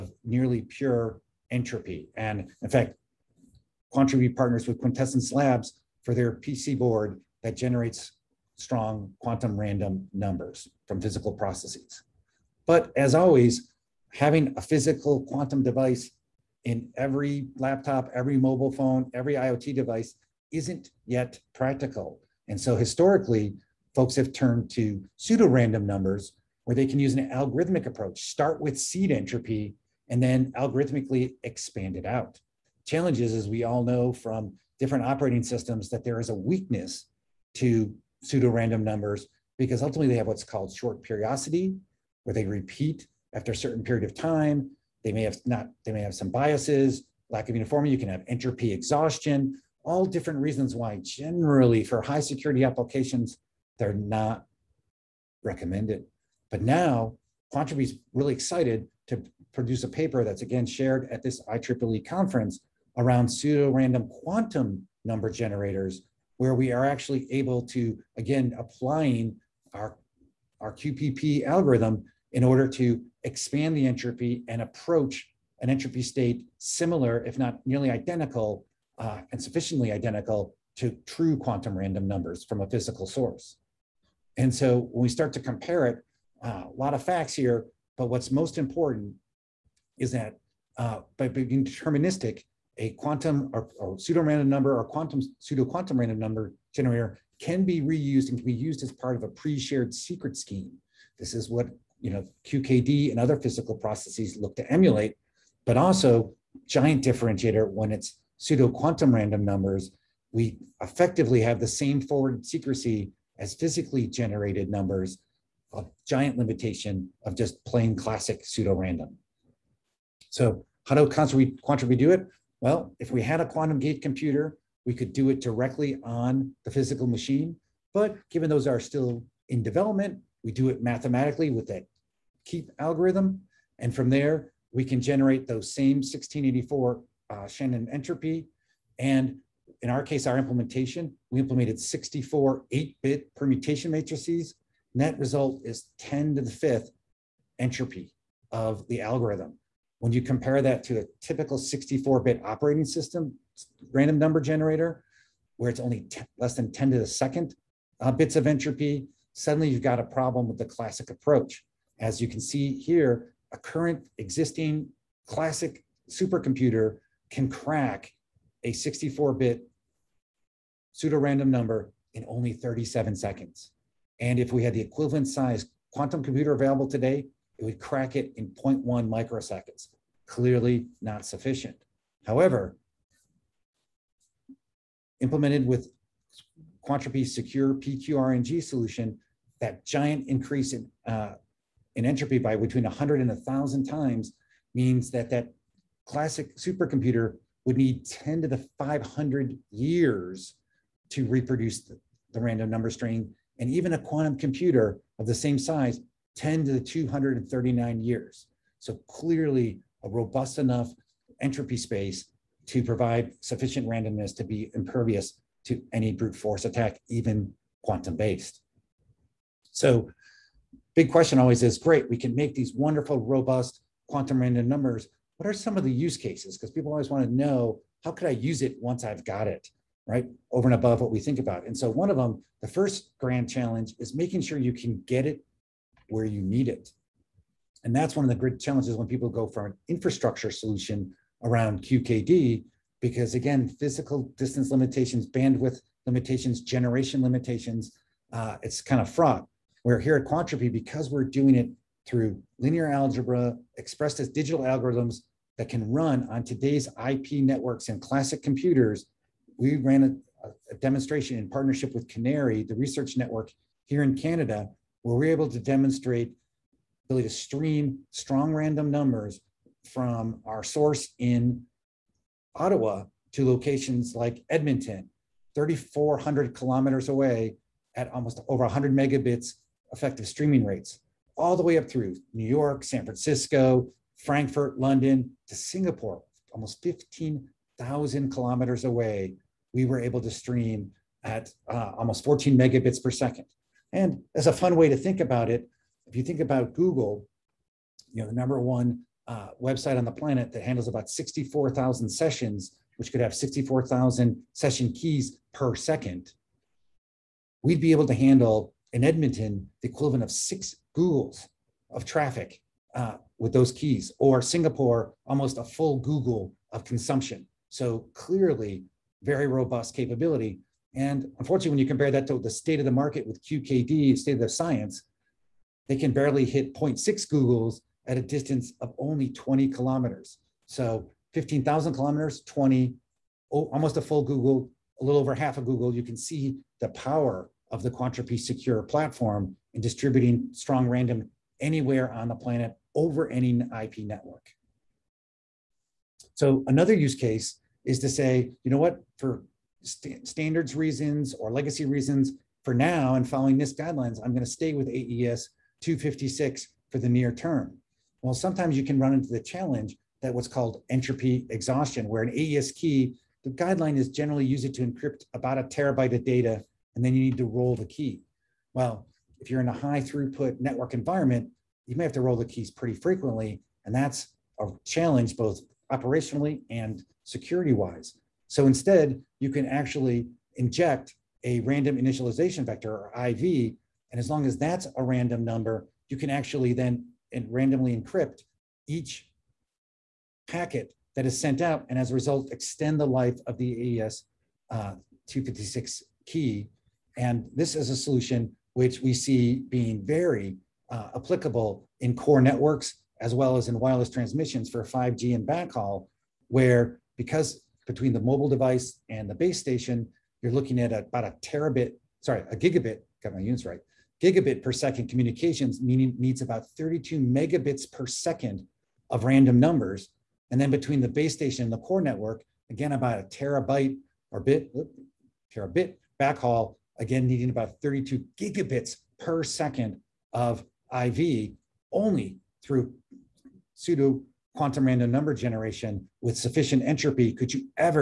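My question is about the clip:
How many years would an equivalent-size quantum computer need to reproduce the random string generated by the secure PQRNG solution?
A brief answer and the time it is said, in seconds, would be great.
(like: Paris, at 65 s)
10^239 years, at 206 s.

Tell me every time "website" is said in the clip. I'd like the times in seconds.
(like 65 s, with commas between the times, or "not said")
299 s.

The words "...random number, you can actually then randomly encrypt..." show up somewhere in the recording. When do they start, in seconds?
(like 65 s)
385 s.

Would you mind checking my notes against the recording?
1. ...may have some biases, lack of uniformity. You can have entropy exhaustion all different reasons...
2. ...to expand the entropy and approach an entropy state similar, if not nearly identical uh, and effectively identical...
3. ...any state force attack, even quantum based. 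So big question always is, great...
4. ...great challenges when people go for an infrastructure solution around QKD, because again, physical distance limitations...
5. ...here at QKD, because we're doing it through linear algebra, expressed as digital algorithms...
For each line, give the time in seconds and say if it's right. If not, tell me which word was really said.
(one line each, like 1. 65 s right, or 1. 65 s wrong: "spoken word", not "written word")
1. 45 s right
2. 72 s wrong: "sufficiently", not "effectively"
3. 215 s wrong: "brute", not "state"
4. 238 s right
5. 249 s wrong: "Quantropi", not "QKD".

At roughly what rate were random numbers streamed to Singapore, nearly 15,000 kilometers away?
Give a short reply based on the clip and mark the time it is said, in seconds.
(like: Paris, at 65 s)
14 megabits per second, at 292 s.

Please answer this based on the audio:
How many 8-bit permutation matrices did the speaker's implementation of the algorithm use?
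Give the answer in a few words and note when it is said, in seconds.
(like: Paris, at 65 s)
64, at 141 s.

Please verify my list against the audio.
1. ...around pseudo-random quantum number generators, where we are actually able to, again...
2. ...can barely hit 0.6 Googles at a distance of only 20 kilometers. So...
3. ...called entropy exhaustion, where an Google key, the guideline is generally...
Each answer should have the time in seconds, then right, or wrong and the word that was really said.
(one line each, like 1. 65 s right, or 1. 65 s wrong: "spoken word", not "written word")
1. 62 s right
2. 325 s right
3. 360 s wrong: "AES", not "Google".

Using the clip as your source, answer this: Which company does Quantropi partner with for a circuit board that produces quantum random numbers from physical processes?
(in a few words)
Quintessence Labs.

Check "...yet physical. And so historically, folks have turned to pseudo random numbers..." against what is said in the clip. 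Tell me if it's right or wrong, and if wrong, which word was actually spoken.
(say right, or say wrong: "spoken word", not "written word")
wrong: "practical", not "physical".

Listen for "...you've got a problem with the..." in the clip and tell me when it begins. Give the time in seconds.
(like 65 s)
159 s.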